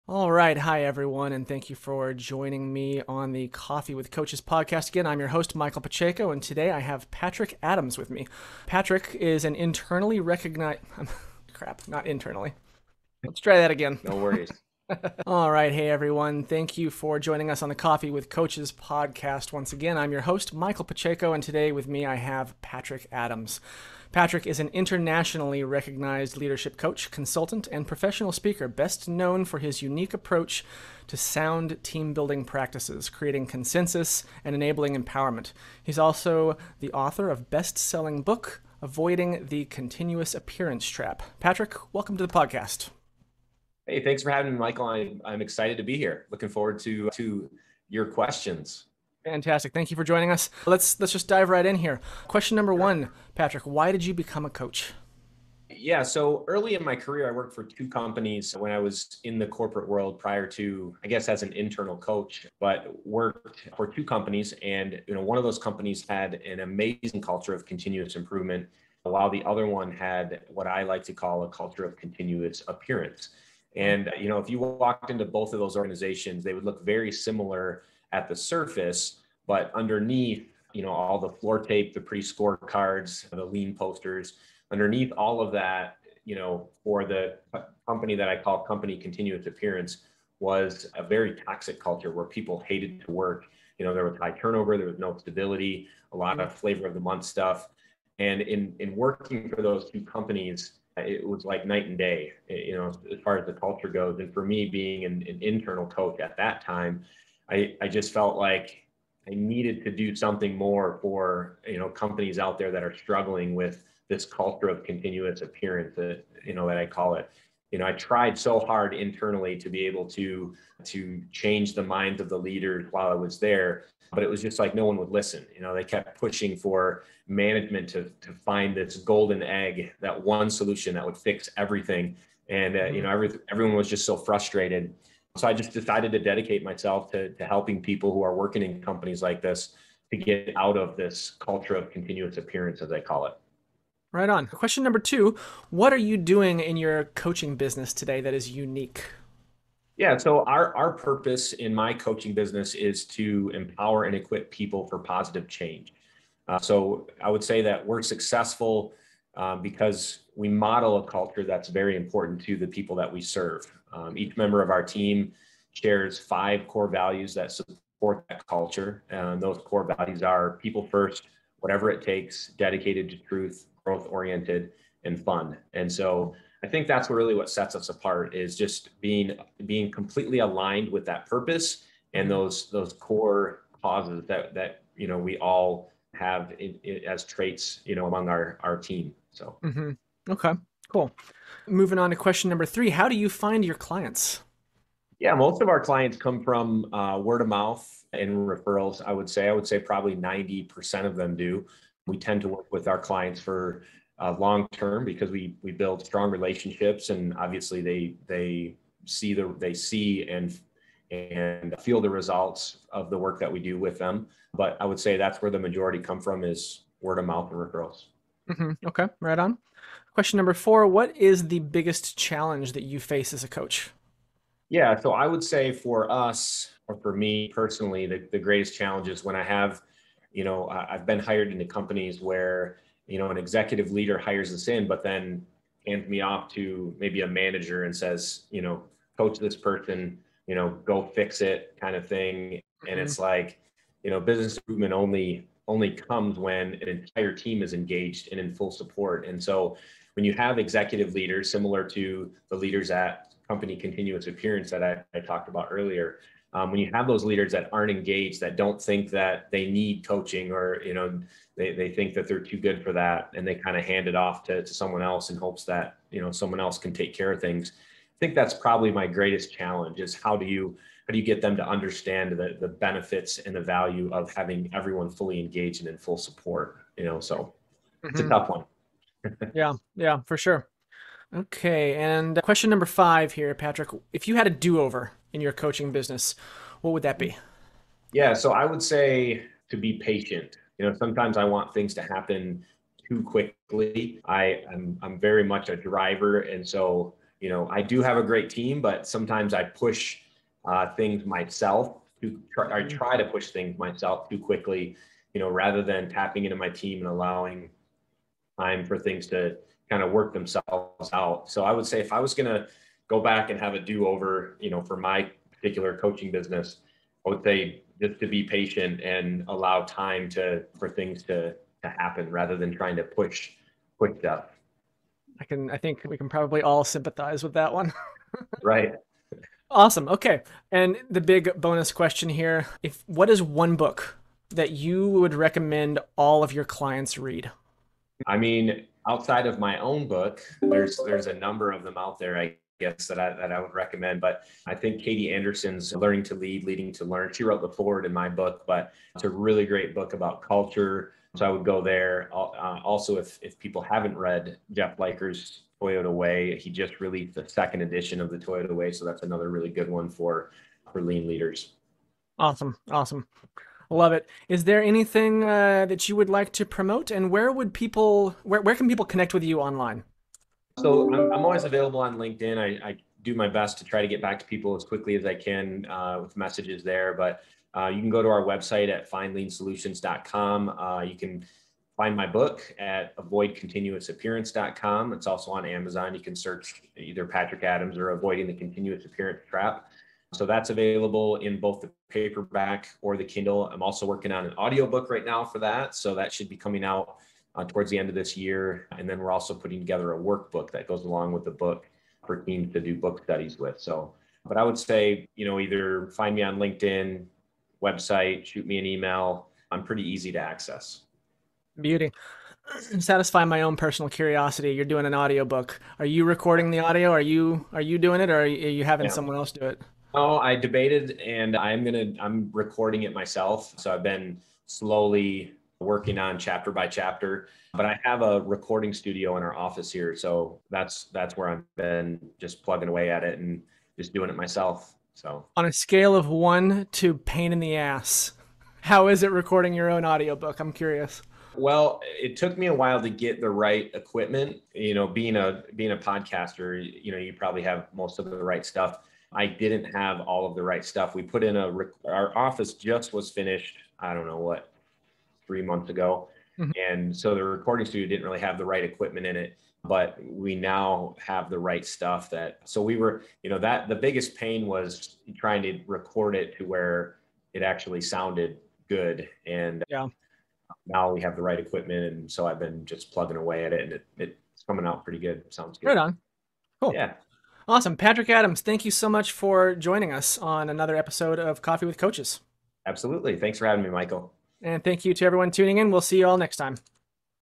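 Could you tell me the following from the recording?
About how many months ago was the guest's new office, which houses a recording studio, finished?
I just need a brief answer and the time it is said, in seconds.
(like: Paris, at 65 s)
3 months, at 455 s.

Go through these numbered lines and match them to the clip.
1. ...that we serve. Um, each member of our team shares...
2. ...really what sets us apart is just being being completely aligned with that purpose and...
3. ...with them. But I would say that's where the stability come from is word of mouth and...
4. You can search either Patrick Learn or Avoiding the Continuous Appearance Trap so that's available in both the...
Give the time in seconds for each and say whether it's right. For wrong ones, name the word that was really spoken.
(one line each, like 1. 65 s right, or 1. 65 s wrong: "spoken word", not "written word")
1. 162 s right
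2. 177 s right
3. 213 s wrong: "majority", not "stability"
4. 386 s wrong: "Adams", not "Learn".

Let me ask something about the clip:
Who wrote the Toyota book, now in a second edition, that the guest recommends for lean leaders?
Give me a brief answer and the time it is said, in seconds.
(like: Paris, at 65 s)
Jeff Liker, at 354 s.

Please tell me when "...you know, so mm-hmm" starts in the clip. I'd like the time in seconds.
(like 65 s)
276 s.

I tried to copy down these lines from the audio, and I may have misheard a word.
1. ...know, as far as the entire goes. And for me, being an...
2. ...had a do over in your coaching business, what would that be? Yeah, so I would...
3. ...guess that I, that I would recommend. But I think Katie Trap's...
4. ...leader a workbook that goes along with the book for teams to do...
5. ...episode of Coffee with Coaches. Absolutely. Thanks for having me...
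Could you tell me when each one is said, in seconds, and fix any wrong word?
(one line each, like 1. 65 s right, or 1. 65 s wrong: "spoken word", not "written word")
1. 102 s wrong: "culture", not "entire"
2. 284 s right
3. 342 s wrong: "Anderson", not "Trap"
4. 399 s wrong: "together", not "leader"
5. 480 s right.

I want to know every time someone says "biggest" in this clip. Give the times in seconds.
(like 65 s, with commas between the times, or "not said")
221 s, 463 s.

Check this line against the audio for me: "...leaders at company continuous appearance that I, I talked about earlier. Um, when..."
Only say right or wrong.
right.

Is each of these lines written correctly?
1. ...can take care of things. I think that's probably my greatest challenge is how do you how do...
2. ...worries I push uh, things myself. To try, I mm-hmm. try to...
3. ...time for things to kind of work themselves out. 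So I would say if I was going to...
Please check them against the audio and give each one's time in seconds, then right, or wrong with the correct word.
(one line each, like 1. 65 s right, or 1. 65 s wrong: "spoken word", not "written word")
1. 266 s right
2. 299 s wrong: "sometimes", not "worries"
3. 308 s right.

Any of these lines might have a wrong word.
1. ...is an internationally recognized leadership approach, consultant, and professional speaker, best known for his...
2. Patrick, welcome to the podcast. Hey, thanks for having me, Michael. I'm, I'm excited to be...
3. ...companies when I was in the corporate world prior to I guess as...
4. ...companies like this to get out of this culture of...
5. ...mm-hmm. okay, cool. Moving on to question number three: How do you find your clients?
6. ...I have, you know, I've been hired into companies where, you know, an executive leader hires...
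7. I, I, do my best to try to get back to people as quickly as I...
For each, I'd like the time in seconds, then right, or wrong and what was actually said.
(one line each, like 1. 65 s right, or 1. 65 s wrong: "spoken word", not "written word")
1. 24 s wrong: "coach", not "approach"
2. 41 s right
3. 57 s right
4. 138 s right
5. 189 s right
6. 229 s right
7. 372 s right.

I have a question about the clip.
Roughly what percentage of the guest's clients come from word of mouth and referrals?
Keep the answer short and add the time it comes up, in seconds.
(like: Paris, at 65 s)
90%, at 200 s.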